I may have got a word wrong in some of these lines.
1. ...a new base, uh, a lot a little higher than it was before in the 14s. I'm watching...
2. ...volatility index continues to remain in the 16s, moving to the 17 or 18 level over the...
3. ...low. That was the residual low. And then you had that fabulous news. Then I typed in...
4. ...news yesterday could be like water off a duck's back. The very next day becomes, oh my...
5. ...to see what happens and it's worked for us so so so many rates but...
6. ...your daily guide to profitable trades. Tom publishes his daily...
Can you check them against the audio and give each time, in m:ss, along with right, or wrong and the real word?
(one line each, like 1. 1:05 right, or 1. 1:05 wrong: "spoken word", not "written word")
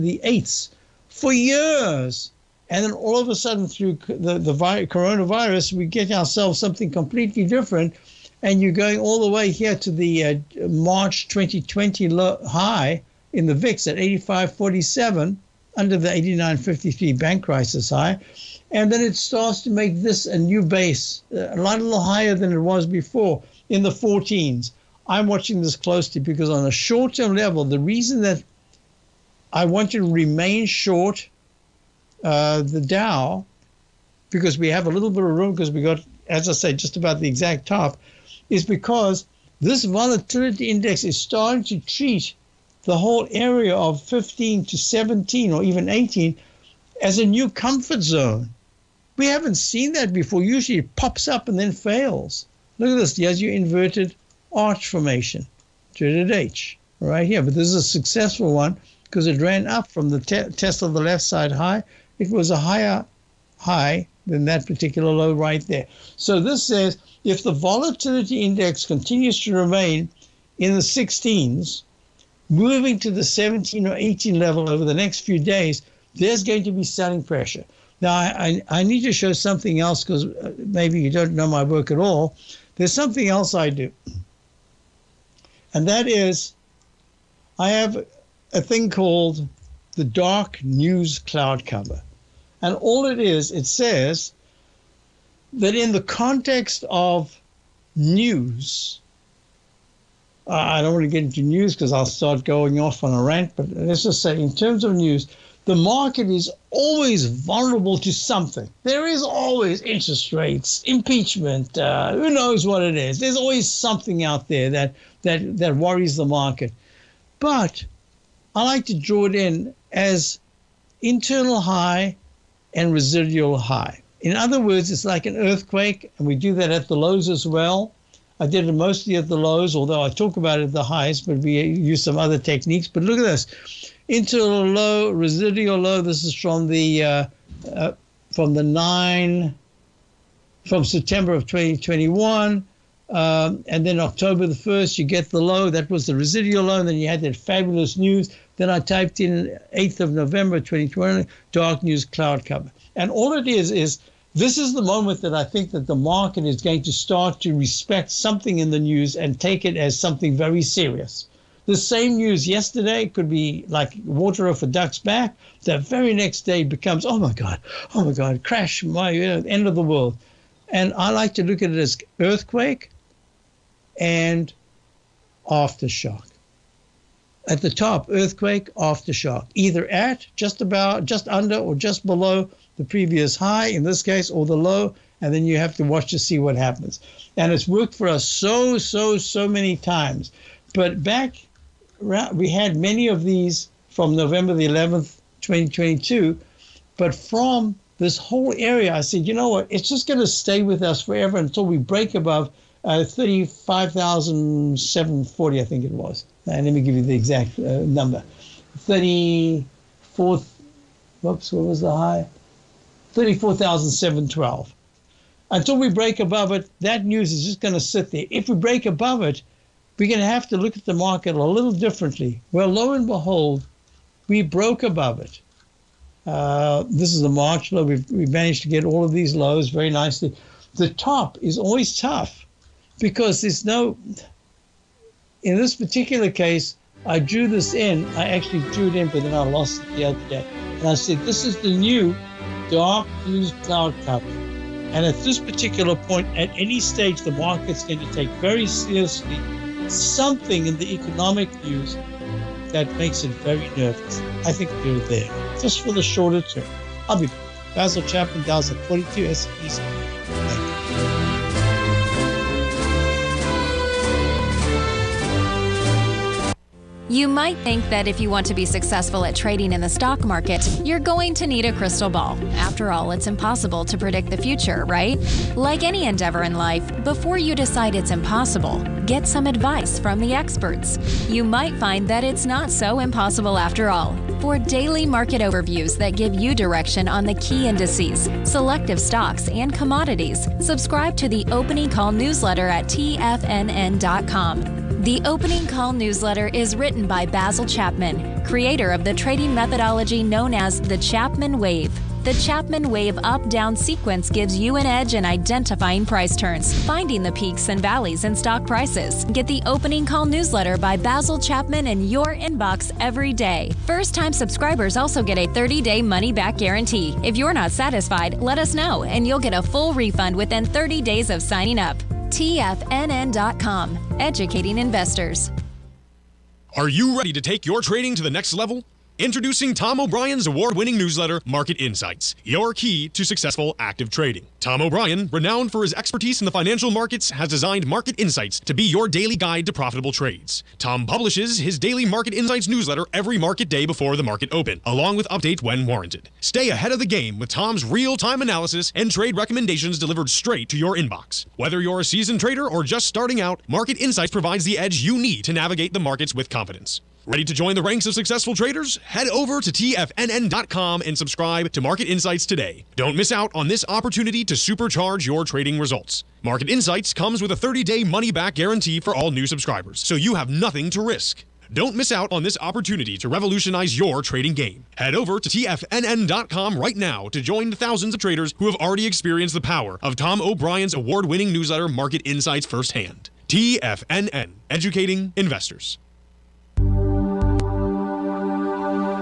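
1. 0:20 right
2. 1:07 right
3. 2:25 right
4. 2:42 right
5. 3:06 wrong: "times", not "rates"
6. 5:38 right.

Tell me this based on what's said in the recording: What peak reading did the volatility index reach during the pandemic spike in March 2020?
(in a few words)
85.47.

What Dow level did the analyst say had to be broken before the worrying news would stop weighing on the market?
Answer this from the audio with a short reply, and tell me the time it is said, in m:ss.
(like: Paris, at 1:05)
34,712, at 3:33.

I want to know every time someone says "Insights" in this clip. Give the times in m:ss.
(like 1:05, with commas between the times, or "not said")
5:31, 5:38, 5:42, 5:53, 6:02, 6:06, 6:22.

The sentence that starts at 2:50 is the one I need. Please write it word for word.
And I like to look at it as earthquake and aftershock.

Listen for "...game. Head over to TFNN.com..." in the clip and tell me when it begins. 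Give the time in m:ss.
6:14.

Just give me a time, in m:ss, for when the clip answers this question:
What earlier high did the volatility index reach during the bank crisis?
0:16.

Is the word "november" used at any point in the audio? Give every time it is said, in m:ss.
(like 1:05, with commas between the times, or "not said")
2:30, 3:14.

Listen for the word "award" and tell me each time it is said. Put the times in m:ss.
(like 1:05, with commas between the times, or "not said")
5:30, 6:20.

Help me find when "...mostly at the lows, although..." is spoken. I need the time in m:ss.
2:08.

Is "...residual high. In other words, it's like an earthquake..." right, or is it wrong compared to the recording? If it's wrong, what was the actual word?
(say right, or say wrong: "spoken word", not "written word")
right.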